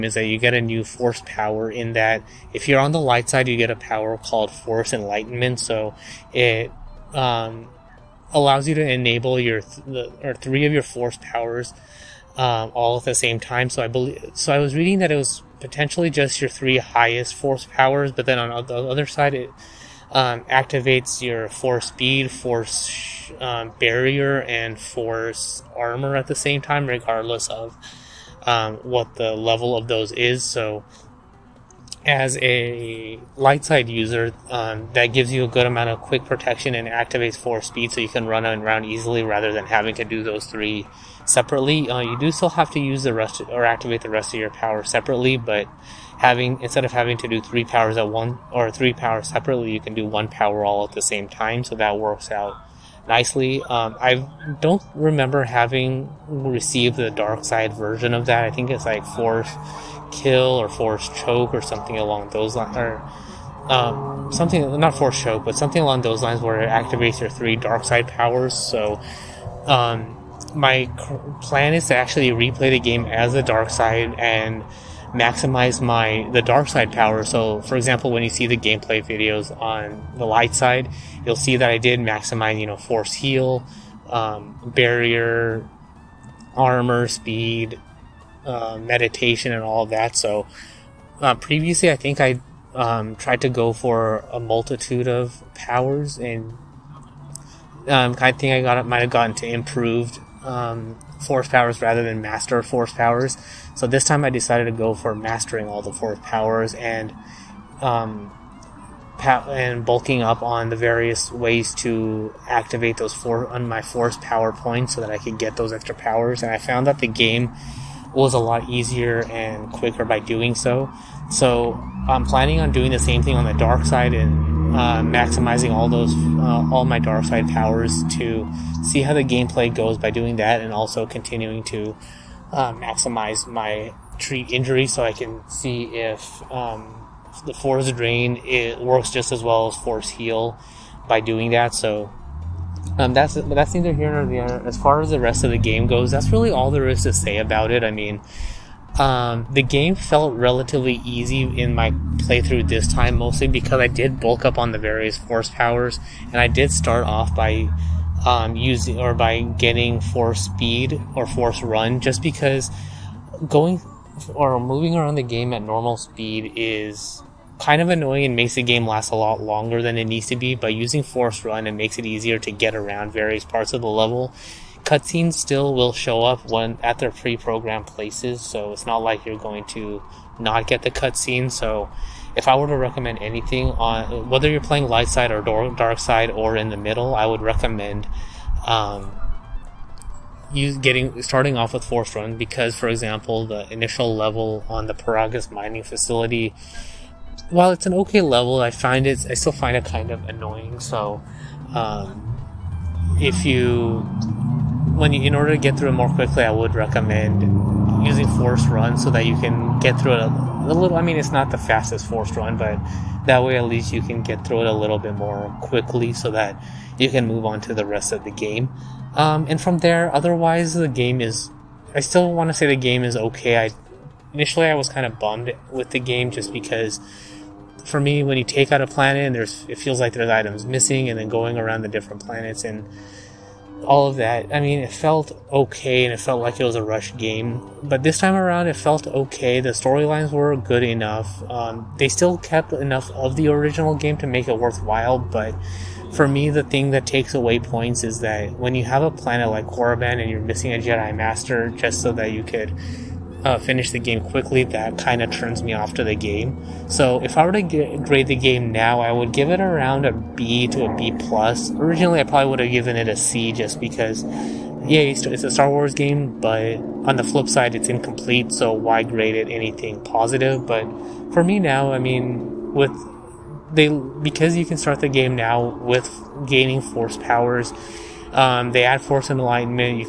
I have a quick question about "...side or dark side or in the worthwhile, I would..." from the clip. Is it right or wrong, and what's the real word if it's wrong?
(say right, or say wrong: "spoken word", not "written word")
wrong: "middle", not "worthwhile".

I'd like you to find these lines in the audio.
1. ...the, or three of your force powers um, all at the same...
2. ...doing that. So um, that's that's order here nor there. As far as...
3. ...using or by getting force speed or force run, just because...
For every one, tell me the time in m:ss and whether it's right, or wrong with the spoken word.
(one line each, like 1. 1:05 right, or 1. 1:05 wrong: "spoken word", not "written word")
1. 0:09 right
2. 2:21 wrong: "neither", not "order"
3. 2:38 right.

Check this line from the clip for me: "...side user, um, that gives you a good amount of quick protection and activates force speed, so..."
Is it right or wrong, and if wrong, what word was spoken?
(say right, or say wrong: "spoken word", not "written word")
right.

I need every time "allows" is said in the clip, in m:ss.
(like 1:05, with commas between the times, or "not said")
0:08.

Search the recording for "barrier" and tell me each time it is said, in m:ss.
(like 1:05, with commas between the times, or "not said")
0:23, 1:24.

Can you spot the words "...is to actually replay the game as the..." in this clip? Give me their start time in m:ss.
1:11.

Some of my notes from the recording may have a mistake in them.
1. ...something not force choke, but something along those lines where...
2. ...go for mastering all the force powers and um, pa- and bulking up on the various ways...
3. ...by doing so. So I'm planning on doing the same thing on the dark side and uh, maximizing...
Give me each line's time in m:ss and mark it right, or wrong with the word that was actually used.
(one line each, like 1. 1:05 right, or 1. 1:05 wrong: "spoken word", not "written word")
1. 1:04 right
2. 1:44 right
3. 2:00 right.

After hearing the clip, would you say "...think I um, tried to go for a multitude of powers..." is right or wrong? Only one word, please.
right.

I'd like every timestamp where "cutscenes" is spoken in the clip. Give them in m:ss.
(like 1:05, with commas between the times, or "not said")
2:54, 3:00.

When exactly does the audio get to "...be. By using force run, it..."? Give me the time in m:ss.
2:50.